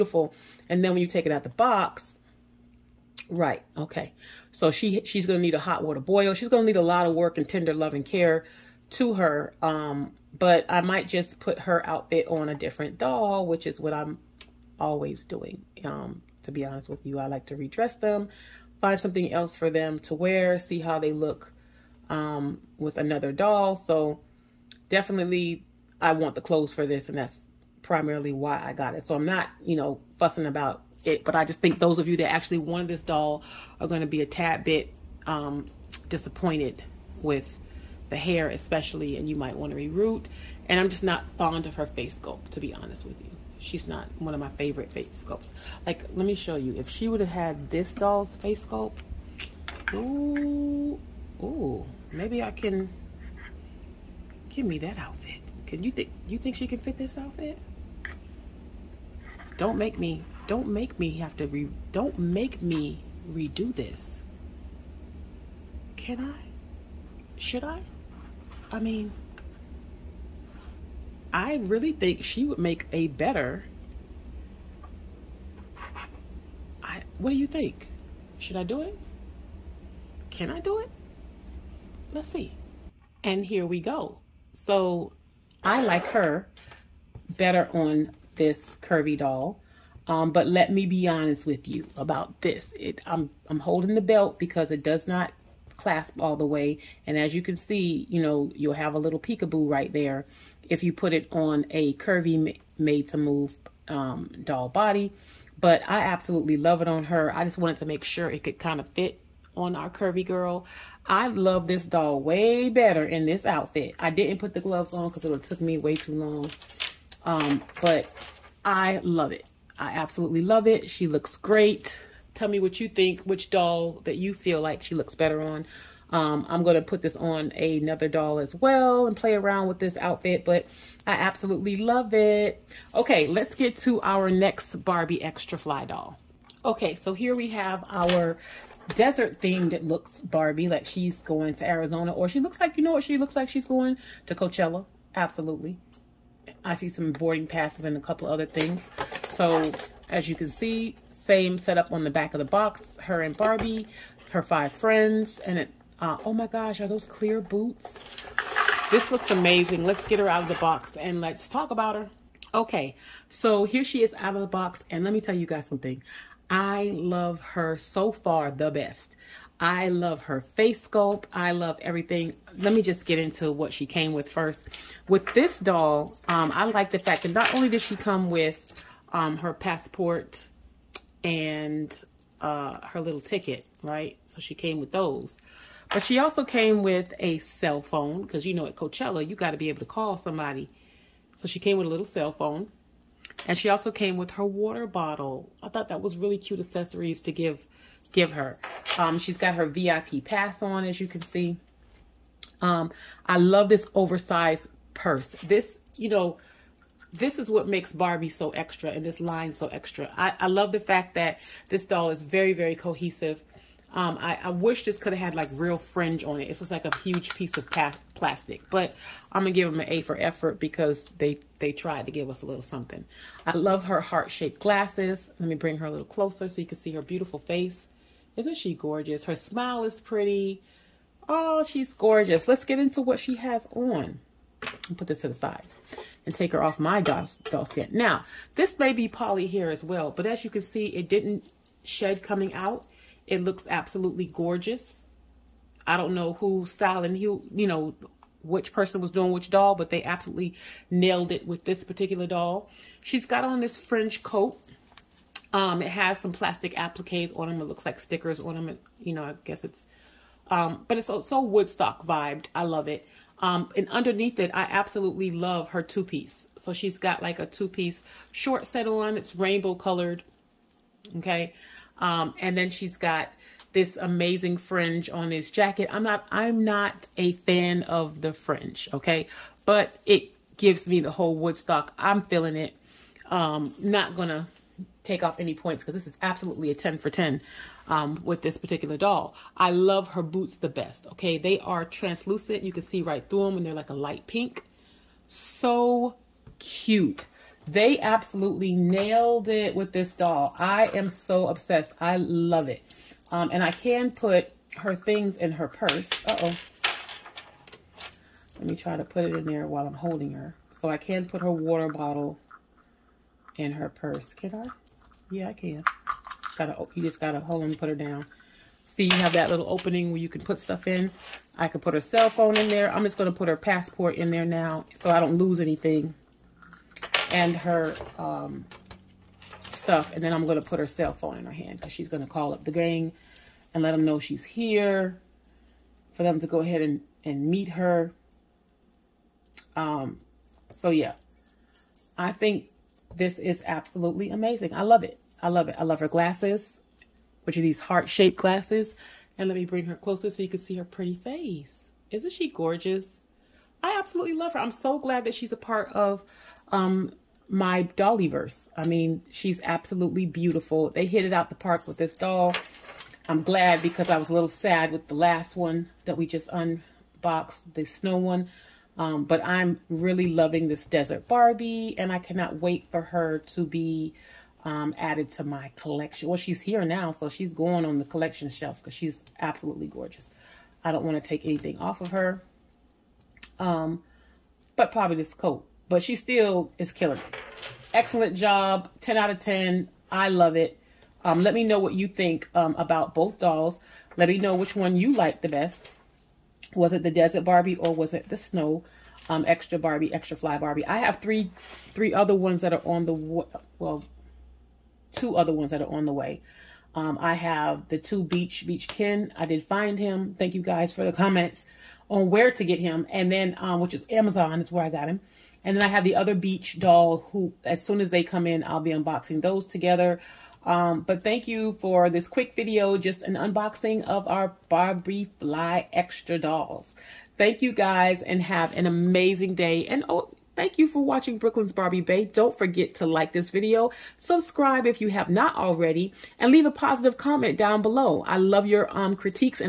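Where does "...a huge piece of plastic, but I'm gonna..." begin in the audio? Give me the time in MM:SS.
03:36.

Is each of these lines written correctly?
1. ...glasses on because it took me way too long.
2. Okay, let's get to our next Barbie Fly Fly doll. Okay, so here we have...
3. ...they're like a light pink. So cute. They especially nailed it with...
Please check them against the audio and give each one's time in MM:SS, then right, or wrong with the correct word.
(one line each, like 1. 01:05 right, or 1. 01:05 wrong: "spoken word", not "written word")
1. 01:54 wrong: "gloves", not "glasses"
2. 02:12 wrong: "Extra", not "Fly"
3. 04:53 wrong: "absolutely", not "especially".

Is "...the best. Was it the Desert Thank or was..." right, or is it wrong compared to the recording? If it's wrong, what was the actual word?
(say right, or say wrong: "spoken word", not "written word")
wrong: "Barbie", not "Thank".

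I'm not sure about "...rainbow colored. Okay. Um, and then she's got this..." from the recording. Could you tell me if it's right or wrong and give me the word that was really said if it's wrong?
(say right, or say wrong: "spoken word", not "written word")
right.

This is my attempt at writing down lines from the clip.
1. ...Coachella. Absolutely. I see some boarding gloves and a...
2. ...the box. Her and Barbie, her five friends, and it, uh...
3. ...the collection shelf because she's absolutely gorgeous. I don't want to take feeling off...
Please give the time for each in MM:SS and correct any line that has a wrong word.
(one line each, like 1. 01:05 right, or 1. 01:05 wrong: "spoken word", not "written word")
1. 02:24 wrong: "passes", not "gloves"
2. 02:32 right
3. 06:17 wrong: "anything", not "feeling".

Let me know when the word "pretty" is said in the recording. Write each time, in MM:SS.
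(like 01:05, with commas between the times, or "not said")
03:50, 05:50.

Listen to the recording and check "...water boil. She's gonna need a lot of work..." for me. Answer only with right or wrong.
right.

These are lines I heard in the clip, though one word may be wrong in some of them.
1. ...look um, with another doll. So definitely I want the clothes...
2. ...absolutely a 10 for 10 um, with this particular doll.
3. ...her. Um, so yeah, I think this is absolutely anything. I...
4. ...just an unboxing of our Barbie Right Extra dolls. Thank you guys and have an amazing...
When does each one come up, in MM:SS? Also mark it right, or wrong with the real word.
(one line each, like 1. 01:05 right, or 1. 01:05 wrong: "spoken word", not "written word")
1. 00:21 right
2. 04:46 right
3. 05:37 wrong: "amazing", not "anything"
4. 07:02 wrong: "Fly", not "Right".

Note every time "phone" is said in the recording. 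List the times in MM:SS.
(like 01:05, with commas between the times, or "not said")
03:07, 03:12, 05:22, 05:31.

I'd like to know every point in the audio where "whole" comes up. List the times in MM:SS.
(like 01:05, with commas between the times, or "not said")
04:41.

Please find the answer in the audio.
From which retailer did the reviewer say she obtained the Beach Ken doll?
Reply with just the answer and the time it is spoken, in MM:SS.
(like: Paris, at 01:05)
Amazon, at 06:54.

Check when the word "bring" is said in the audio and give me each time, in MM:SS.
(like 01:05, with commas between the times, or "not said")
03:45, 05:49.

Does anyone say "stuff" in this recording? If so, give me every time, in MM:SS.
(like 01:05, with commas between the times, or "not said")
05:20, 05:29.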